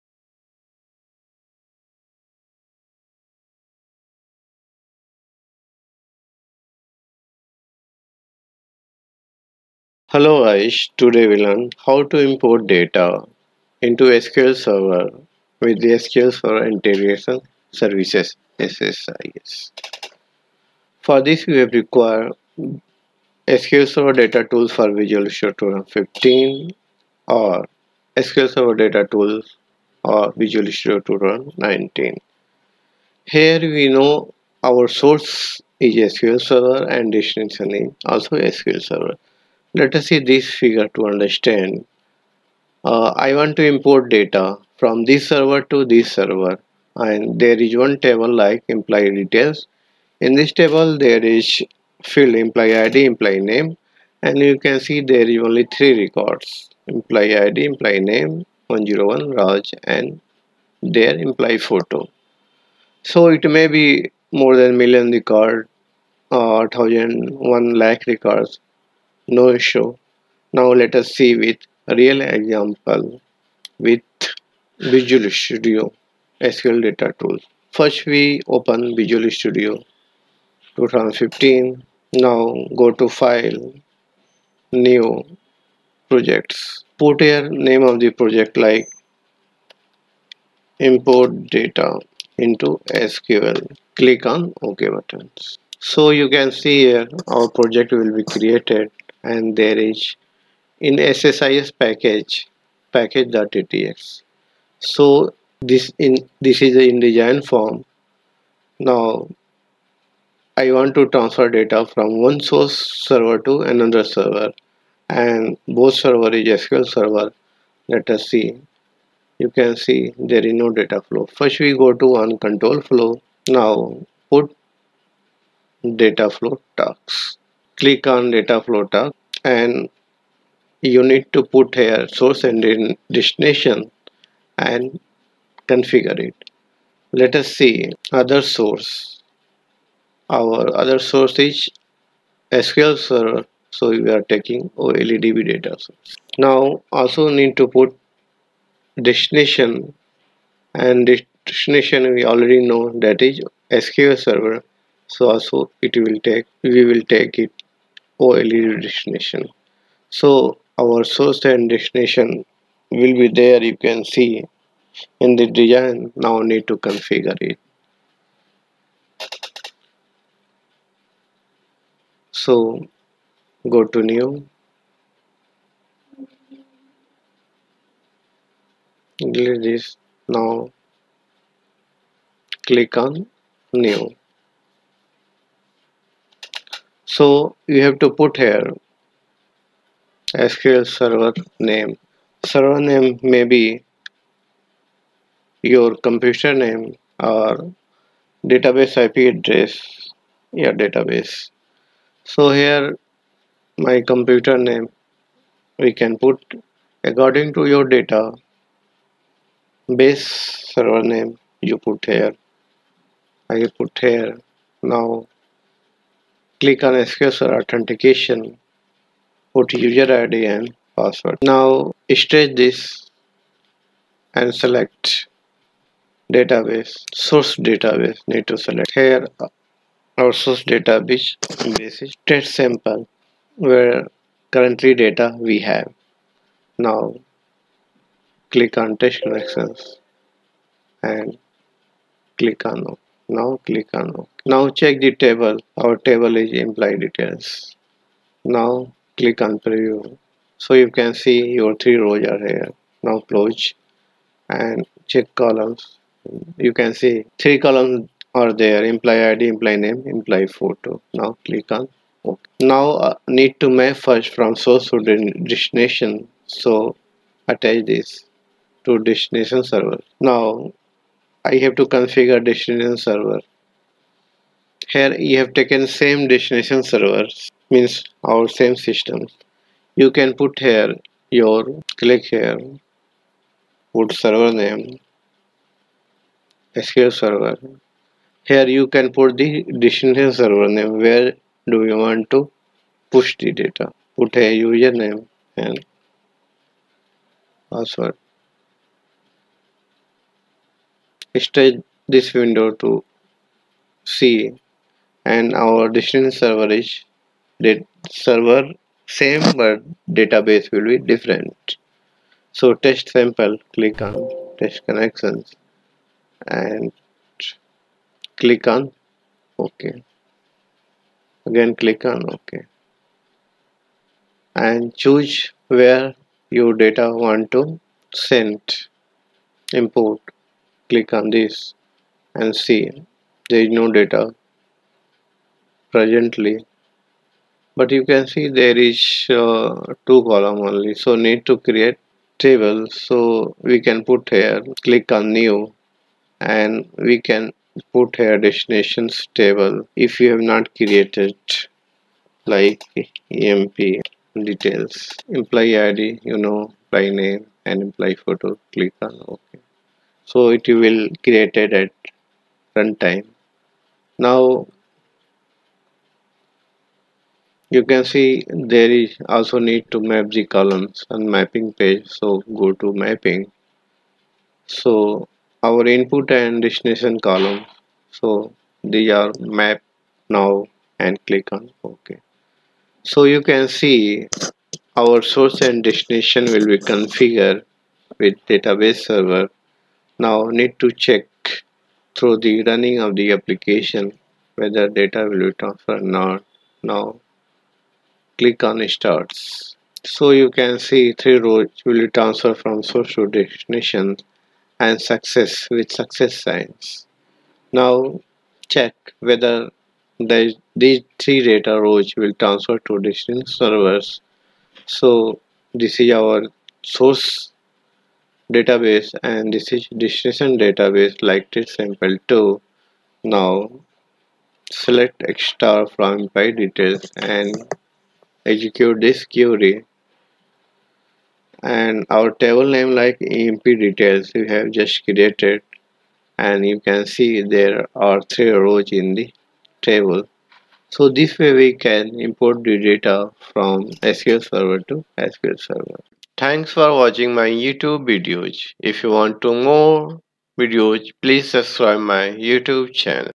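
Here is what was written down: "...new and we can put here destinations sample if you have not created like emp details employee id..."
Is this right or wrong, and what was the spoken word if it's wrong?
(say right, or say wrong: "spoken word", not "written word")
wrong: "table", not "sample".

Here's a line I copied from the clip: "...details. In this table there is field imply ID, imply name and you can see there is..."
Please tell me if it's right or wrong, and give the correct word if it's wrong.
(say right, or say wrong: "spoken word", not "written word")
right.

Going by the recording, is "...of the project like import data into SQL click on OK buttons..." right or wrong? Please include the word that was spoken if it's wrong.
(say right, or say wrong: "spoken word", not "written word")
right.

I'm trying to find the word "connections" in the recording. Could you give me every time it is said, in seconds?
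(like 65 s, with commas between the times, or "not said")
239 s, 314 s.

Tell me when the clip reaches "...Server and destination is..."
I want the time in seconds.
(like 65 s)
36 s.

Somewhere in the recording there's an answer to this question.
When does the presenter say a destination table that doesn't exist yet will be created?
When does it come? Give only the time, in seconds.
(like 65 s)
362 s.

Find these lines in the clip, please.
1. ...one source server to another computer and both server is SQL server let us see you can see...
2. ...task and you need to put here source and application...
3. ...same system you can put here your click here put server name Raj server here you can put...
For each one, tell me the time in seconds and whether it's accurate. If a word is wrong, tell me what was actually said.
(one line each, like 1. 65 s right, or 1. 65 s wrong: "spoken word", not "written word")
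1. 112 s wrong: "server", not "computer"
2. 128 s wrong: "destination", not "application"
3. 278 s wrong: "SQL", not "Raj".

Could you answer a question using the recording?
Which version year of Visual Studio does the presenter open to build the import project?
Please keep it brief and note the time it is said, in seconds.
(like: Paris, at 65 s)
2015, at 78 s.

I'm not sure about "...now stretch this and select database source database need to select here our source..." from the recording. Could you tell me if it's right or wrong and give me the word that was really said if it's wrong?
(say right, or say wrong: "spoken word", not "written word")
right.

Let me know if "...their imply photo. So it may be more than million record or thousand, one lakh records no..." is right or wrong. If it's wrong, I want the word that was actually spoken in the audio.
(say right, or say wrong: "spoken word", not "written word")
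right.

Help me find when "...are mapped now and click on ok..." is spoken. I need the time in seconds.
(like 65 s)
379 s.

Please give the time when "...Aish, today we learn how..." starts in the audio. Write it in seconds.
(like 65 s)
10 s.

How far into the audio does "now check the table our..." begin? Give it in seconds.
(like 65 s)
244 s.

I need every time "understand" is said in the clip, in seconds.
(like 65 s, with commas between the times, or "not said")
41 s.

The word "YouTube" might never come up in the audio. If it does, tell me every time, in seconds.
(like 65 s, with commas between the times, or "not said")
447 s, 452 s.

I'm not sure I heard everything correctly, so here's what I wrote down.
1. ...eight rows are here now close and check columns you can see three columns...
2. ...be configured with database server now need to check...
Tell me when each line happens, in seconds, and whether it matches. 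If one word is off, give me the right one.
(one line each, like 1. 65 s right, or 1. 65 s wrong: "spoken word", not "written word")
1. 251 s wrong: "three", not "eight"
2. 386 s right.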